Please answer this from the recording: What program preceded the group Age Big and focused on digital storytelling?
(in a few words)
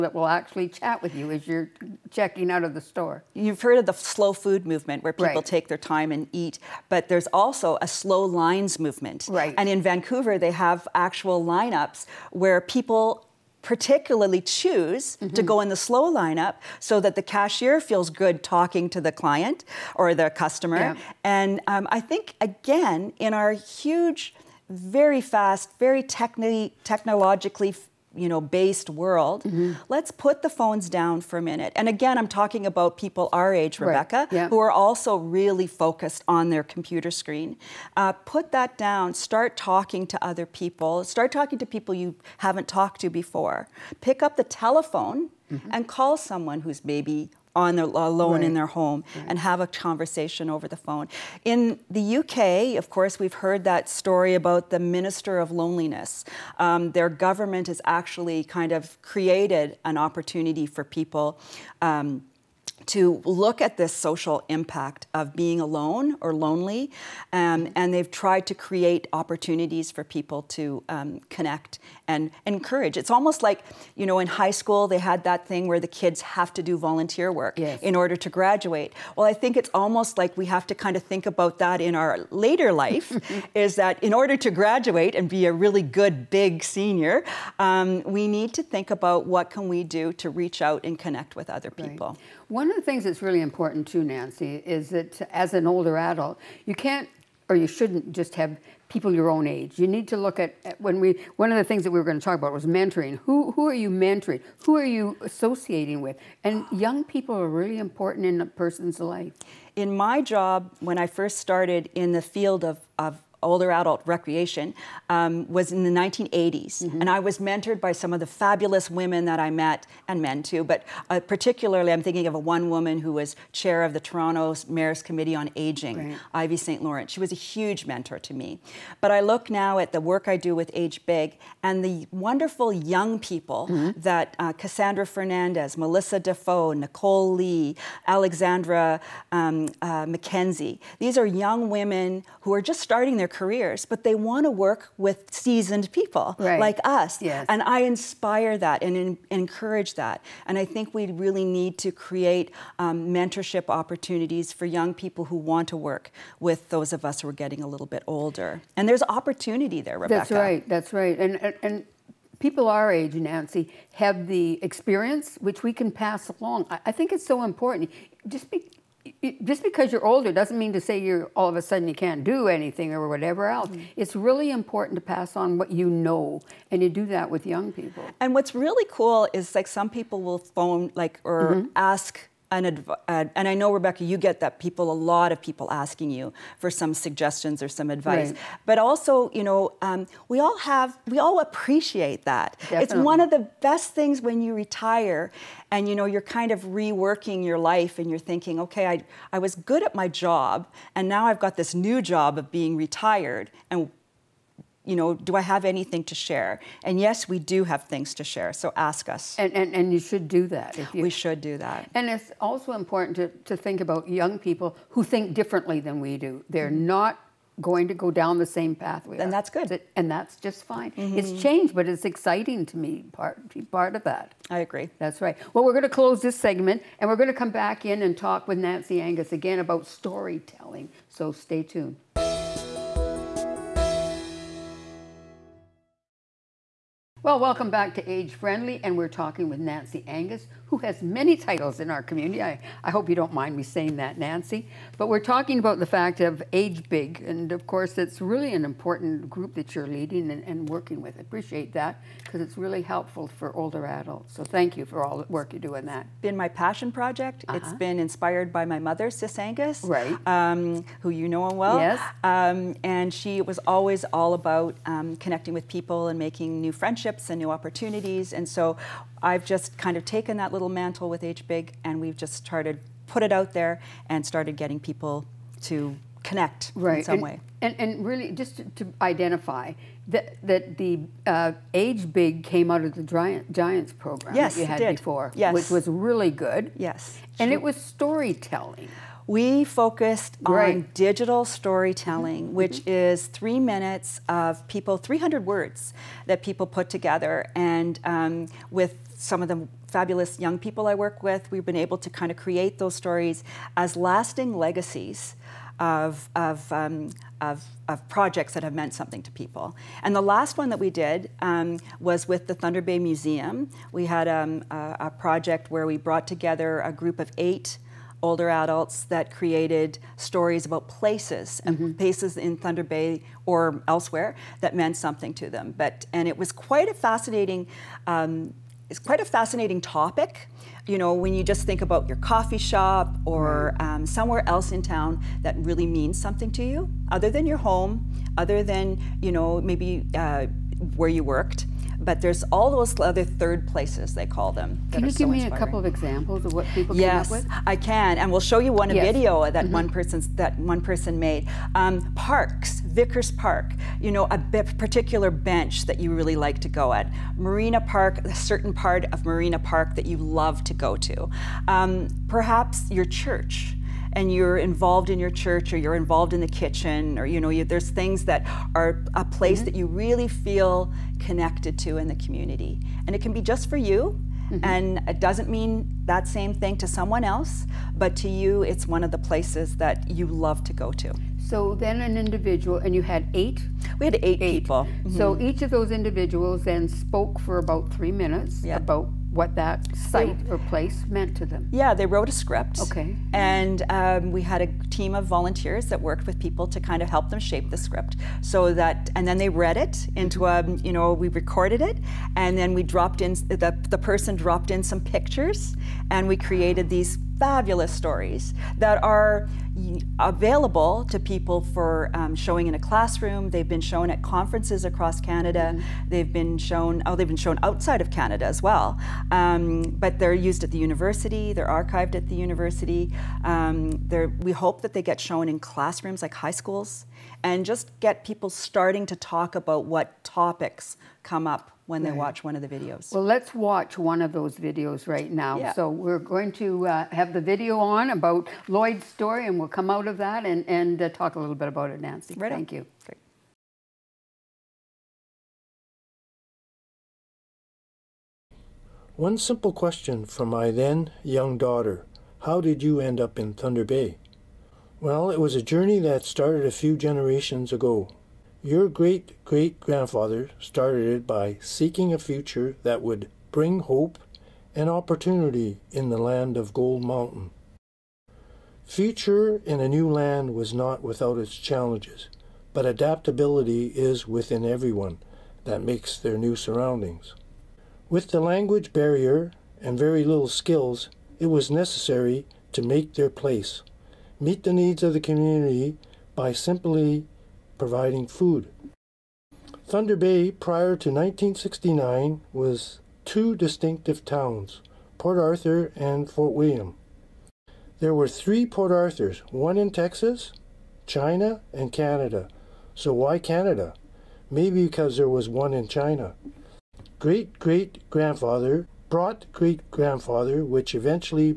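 Giants program.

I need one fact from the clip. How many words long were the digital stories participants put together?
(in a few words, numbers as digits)
300.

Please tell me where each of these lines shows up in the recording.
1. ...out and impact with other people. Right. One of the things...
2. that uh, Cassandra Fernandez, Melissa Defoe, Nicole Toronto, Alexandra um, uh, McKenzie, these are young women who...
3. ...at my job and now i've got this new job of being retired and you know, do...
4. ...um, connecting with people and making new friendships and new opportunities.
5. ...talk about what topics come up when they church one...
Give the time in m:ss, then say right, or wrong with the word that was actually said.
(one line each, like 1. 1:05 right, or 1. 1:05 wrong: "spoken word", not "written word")
1. 1:30 wrong: "connect", not "impact"
2. 2:13 wrong: "Lee", not "Toronto"
3. 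3:19 right
4. 4:24 right
5. 7:09 wrong: "watch", not "church".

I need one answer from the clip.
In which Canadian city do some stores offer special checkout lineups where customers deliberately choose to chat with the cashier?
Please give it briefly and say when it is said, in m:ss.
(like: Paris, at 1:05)
Vancouver, at 0:09.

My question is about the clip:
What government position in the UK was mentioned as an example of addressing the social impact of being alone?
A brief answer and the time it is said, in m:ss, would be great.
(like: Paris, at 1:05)
Minister of Loneliness, at 0:54.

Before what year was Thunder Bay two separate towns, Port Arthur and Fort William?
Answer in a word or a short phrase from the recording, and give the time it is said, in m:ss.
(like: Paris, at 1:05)
1969, at 8:11.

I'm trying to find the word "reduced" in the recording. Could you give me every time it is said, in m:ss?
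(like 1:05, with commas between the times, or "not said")
not said.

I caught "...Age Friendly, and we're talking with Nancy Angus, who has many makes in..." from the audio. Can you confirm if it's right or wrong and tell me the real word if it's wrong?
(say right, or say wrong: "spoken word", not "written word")
wrong: "titles", not "makes".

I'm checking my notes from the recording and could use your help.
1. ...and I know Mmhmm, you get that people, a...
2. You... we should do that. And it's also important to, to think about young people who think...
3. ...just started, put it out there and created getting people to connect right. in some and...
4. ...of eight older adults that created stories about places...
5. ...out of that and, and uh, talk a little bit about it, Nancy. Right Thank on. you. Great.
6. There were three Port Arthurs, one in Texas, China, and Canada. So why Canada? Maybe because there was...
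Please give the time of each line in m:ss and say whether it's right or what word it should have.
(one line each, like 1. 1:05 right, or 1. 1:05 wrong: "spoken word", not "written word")
1. 3:03 wrong: "Rebecca", not "Mmhmm"
2. 3:30 right
3. 4:32 wrong: "started", not "created"
4. 5:17 right
5. 7:19 right
6. 8:18 right.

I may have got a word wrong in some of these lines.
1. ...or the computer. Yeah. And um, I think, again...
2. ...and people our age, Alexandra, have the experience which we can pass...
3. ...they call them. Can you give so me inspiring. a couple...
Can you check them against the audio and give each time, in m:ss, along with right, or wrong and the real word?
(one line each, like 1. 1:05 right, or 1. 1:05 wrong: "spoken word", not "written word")
1. 0:19 wrong: "customer", not "computer"
2. 2:41 wrong: "Nancy", not "Alexandra"
3. 5:44 right.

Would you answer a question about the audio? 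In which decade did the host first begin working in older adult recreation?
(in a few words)
1980s.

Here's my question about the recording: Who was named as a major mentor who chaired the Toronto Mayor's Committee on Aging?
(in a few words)
Ivy St. Laurent.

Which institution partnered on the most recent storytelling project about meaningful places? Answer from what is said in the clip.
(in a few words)
Thunder Bay Museum.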